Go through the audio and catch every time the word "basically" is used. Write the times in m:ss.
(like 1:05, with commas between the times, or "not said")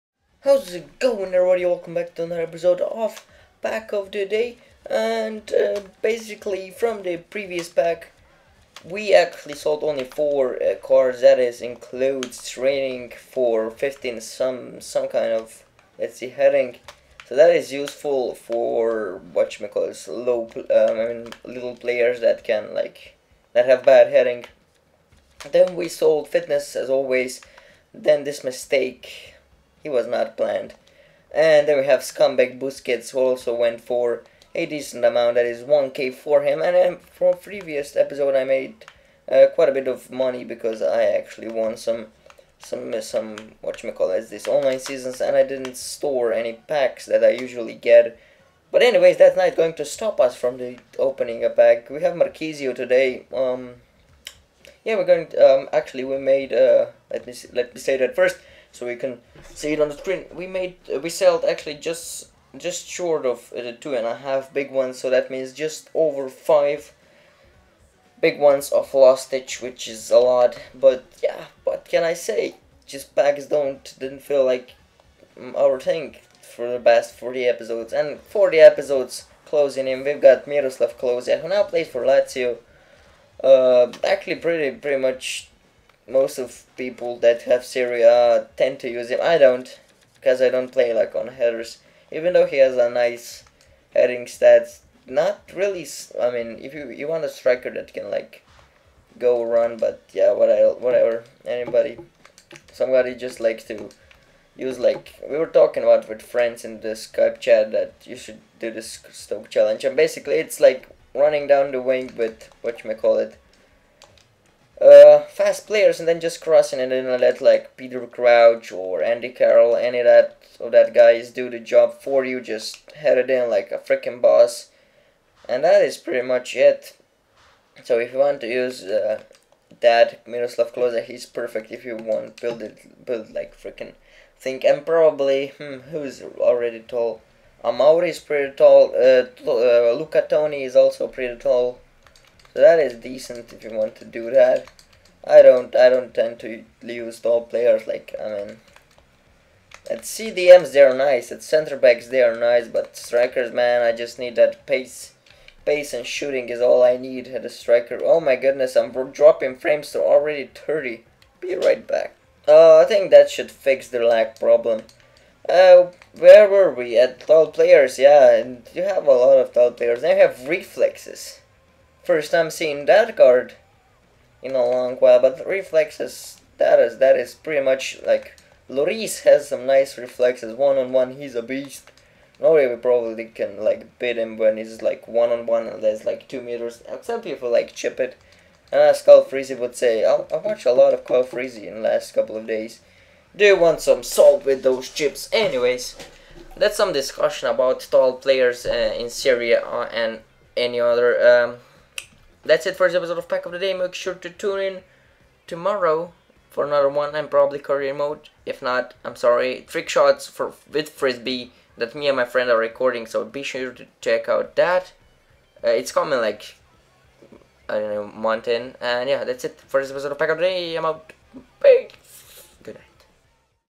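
0:06, 1:49.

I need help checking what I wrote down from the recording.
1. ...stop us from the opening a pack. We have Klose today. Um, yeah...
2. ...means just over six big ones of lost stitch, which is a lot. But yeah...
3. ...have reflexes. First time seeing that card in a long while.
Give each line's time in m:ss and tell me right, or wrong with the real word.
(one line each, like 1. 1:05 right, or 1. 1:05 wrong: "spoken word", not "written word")
1. 0:49 wrong: "Marchisio", not "Klose"
2. 1:05 wrong: "five", not "six"
3. 2:50 right.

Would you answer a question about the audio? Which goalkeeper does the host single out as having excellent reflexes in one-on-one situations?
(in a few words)
Lloris.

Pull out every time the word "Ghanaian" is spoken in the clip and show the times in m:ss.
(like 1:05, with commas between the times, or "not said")
not said.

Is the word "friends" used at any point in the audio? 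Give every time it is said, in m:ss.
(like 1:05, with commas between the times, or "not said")
1:46, 3:32.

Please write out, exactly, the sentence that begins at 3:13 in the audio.
Do you want some salt with those chips?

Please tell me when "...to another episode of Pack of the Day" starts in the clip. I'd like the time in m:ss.
0:02.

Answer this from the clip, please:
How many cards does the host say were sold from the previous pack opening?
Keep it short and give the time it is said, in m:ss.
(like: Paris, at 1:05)
4, at 0:10.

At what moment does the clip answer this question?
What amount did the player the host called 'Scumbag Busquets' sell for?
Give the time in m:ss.
0:35.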